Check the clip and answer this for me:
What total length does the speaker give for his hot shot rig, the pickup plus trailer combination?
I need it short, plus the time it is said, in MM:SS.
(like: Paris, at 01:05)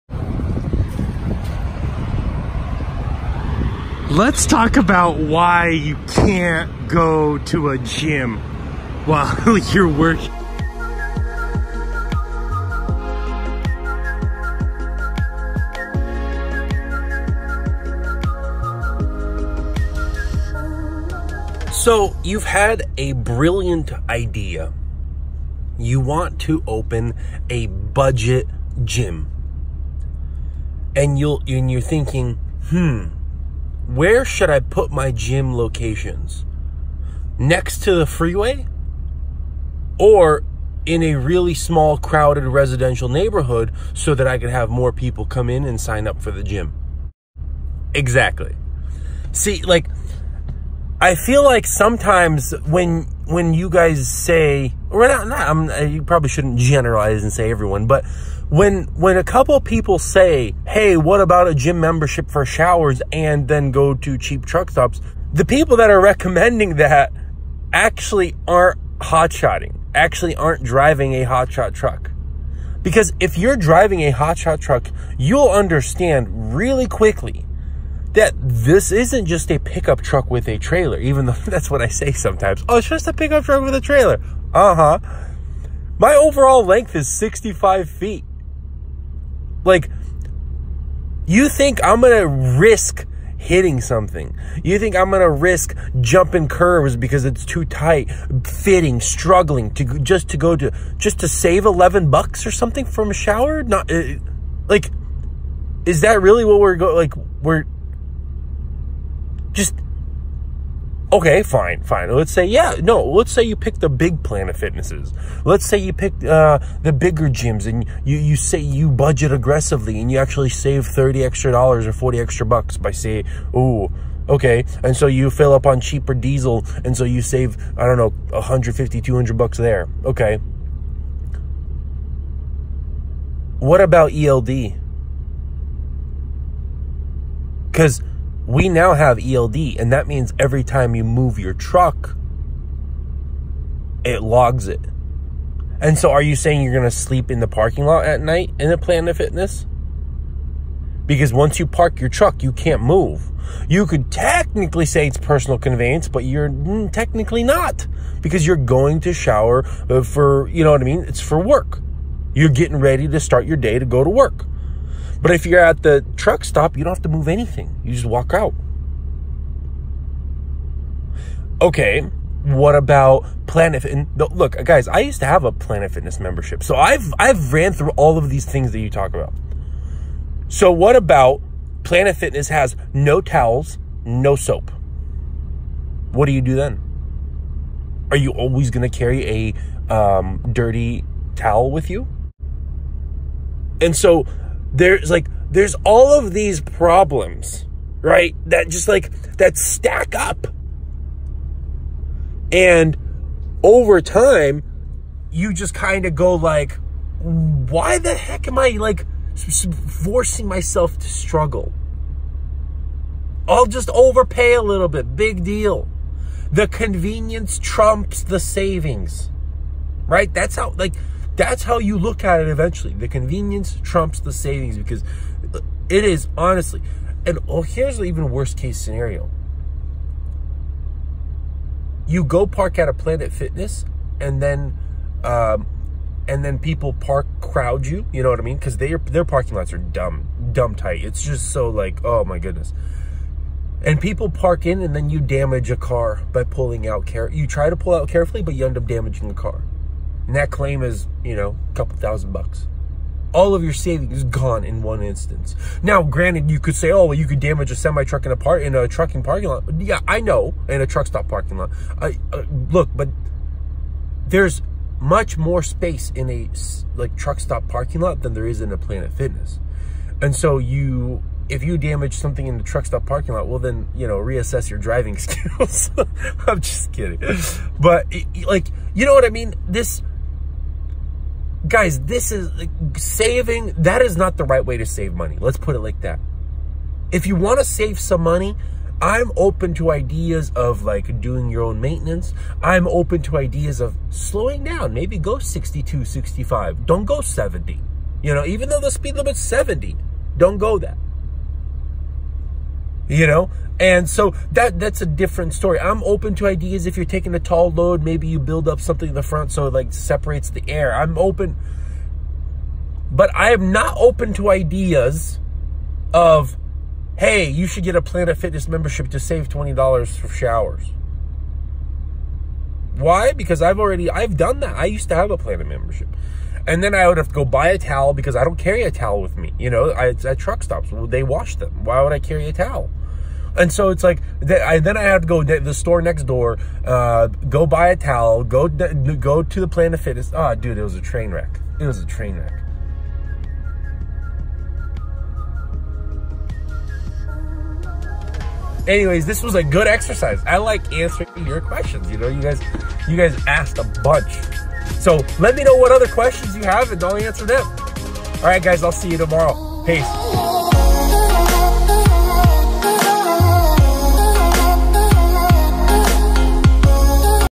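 65 feet, at 01:27.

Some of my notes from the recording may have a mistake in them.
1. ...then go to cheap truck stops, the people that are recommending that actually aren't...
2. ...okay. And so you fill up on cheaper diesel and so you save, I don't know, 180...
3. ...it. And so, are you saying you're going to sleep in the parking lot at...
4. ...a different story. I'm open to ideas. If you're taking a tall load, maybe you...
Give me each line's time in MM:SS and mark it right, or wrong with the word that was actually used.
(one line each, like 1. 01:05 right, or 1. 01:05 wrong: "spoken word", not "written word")
1. 01:03 right
2. 02:04 wrong: "150", not "180"
3. 02:24 right
4. 05:05 right.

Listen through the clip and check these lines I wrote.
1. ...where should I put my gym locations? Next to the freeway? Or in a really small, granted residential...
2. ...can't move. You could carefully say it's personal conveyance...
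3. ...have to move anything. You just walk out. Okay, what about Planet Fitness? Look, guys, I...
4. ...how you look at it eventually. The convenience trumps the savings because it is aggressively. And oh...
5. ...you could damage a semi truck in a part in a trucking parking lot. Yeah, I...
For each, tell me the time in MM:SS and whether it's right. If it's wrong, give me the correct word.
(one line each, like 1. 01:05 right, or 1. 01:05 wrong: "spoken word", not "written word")
1. 00:33 wrong: "crowded", not "granted"
2. 02:32 wrong: "technically", not "carefully"
3. 02:46 right
4. 03:41 wrong: "honestly", not "aggressively"
5. 04:17 right.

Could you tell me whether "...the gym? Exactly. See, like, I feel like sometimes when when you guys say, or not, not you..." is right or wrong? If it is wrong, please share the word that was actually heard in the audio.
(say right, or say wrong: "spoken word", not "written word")
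right.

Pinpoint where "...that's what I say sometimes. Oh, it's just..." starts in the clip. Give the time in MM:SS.
01:21.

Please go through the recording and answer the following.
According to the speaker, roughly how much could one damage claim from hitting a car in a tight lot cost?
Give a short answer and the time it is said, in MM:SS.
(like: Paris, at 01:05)
a couple thousand bucks, at 04:11.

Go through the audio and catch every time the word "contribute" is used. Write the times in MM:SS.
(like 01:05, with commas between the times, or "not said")
not said.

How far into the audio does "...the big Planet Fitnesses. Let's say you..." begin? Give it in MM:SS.
01:53.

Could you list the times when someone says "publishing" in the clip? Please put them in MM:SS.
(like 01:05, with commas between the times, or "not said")
not said.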